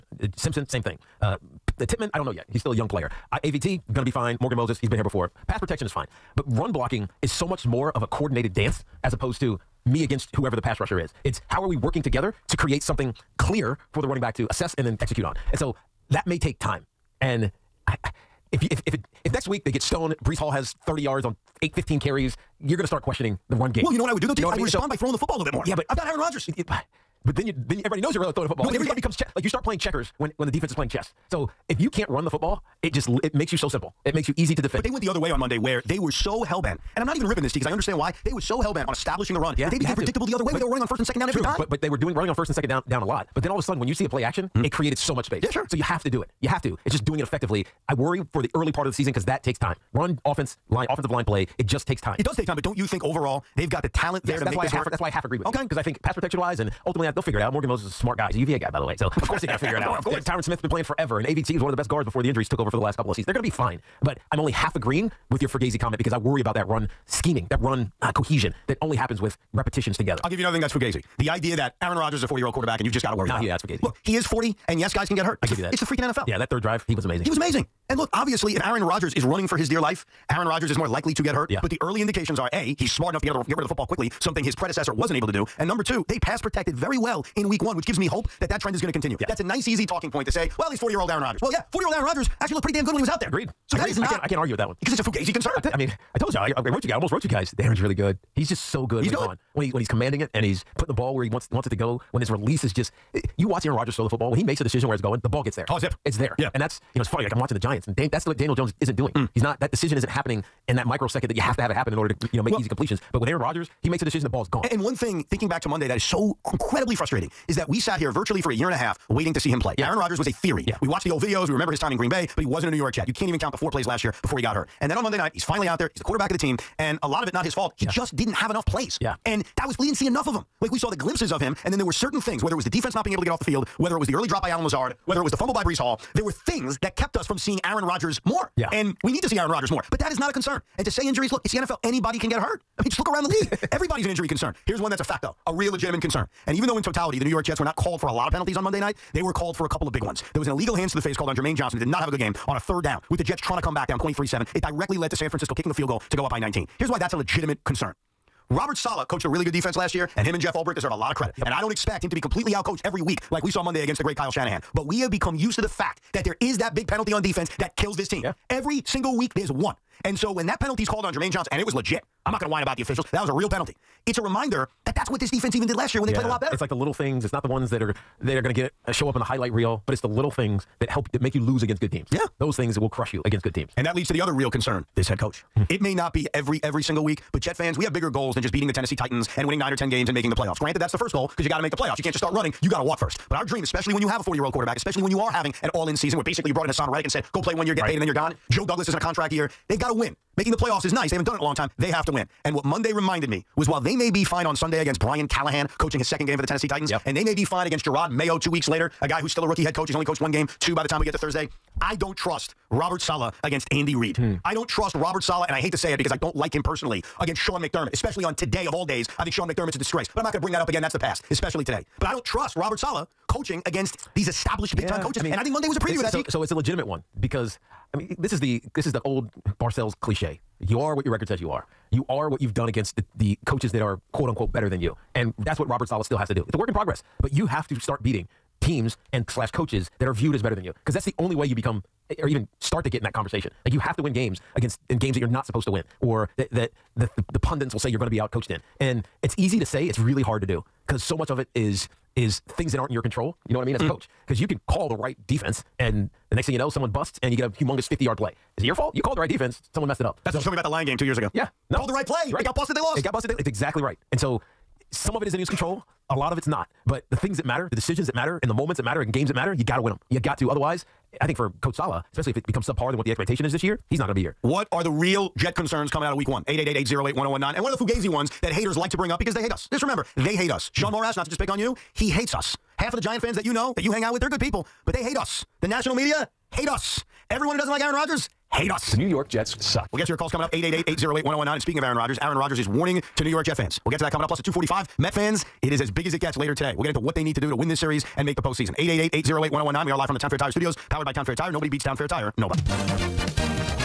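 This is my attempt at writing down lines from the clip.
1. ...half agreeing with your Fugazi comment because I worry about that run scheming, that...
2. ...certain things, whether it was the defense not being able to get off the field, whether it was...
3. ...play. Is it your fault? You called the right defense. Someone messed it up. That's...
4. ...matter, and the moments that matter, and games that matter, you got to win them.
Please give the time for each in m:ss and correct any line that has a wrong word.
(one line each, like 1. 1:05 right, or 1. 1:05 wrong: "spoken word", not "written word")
1. 1:04 right
2. 2:11 right
3. 4:18 right
4. 4:28 right.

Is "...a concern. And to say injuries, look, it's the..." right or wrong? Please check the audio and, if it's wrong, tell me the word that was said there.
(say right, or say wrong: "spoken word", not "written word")
right.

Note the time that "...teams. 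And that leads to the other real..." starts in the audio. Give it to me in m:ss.
3:03.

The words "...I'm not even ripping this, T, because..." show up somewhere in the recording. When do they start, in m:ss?
0:37.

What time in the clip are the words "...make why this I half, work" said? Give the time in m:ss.
0:54.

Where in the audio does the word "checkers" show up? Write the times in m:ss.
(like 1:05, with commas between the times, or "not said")
0:29.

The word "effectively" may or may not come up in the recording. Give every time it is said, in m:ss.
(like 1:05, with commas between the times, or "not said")
0:47.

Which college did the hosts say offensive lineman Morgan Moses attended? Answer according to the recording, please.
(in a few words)
UVA.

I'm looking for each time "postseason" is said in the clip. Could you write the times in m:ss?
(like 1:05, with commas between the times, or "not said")
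4:58.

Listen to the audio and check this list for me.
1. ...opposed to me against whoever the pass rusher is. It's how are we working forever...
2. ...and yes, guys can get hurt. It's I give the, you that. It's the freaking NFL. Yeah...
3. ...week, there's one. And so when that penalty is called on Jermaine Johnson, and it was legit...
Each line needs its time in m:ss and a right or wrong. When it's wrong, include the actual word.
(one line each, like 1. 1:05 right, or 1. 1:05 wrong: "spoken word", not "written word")
1. 0:09 wrong: "together", not "forever"
2. 1:14 right
3. 2:49 right.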